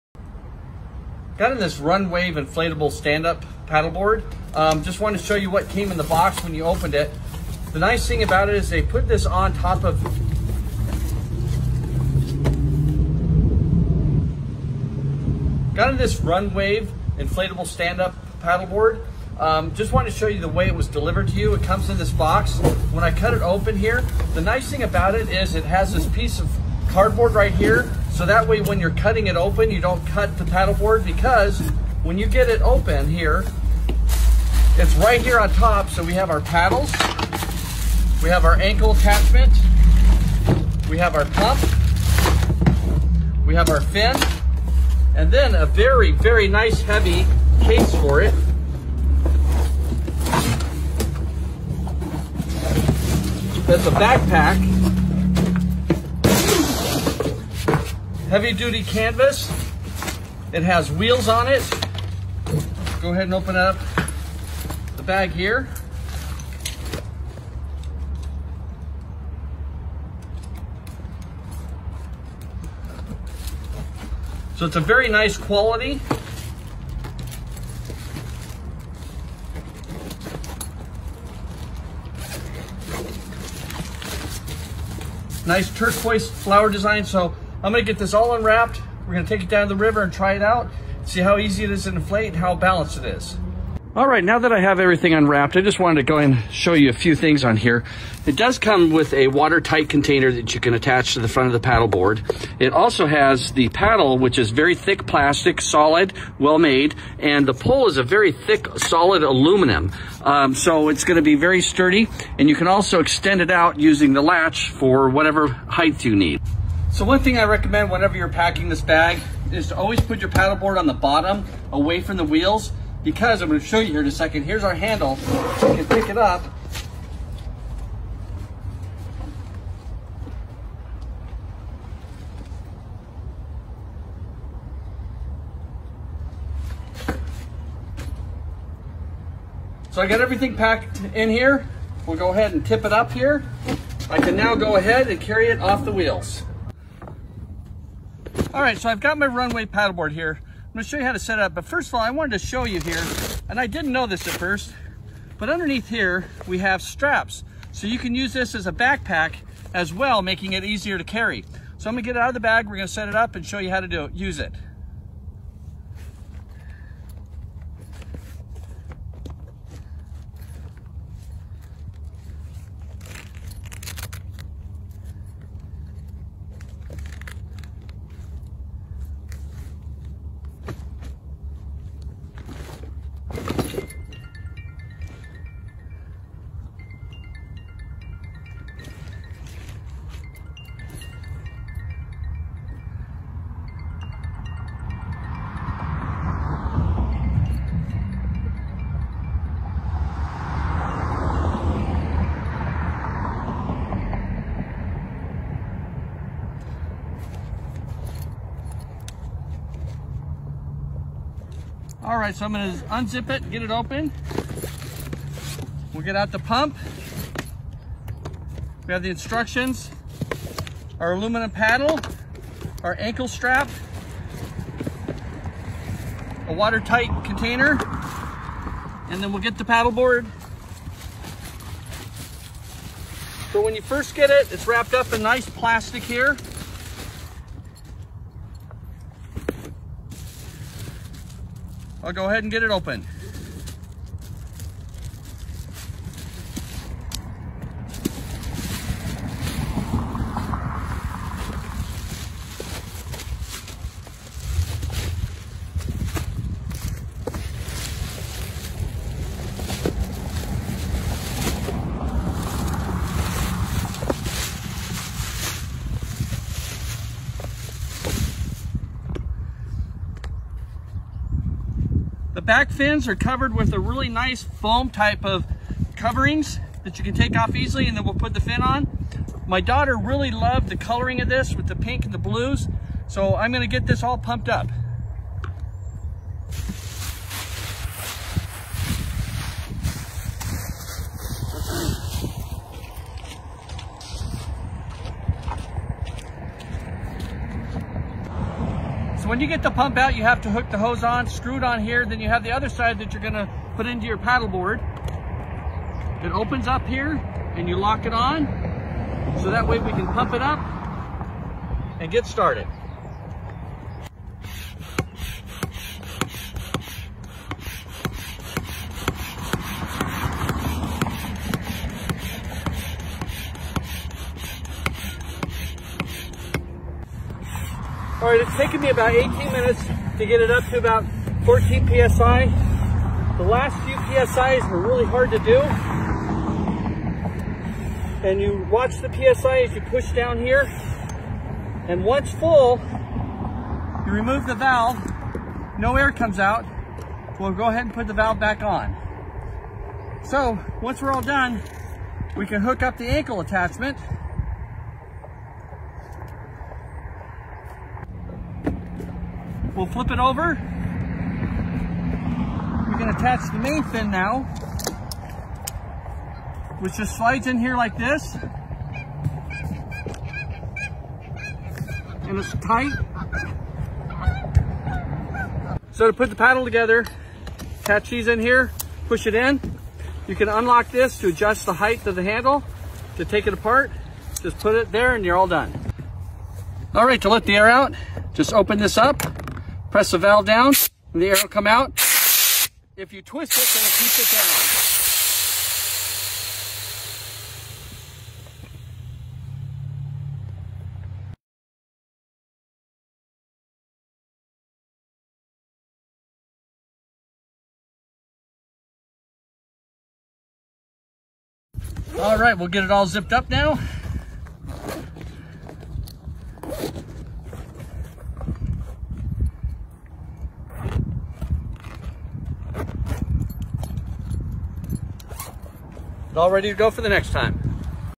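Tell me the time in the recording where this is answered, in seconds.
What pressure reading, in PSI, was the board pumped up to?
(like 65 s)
331 s.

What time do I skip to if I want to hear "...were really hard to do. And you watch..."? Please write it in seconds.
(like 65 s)
334 s.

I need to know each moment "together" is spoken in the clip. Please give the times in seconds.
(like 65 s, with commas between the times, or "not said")
376 s.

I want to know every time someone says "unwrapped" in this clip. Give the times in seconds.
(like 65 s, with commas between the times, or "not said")
88 s, 95 s.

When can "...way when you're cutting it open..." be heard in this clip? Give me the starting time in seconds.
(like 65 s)
28 s.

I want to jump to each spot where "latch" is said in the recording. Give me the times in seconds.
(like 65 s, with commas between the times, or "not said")
114 s.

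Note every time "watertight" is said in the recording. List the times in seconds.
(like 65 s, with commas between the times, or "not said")
99 s, 226 s.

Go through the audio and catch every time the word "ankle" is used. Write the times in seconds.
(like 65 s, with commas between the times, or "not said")
38 s, 222 s, 353 s.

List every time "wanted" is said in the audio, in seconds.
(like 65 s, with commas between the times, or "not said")
4 s, 19 s, 95 s, 152 s.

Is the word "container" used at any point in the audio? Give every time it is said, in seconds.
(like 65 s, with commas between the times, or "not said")
99 s, 227 s.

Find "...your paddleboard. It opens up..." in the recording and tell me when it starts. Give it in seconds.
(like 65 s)
304 s.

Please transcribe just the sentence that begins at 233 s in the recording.
So when you first get it, it's wrapped up in nice plastic here.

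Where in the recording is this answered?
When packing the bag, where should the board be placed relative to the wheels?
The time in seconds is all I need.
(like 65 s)
120 s.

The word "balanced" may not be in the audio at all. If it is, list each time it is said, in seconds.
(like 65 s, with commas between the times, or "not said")
92 s.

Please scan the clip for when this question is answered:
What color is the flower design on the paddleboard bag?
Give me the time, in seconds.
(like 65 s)
85 s.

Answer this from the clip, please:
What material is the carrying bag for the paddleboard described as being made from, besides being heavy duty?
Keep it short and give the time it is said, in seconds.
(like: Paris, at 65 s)
canvas, at 58 s.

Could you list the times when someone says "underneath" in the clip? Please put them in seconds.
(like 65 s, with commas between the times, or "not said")
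155 s.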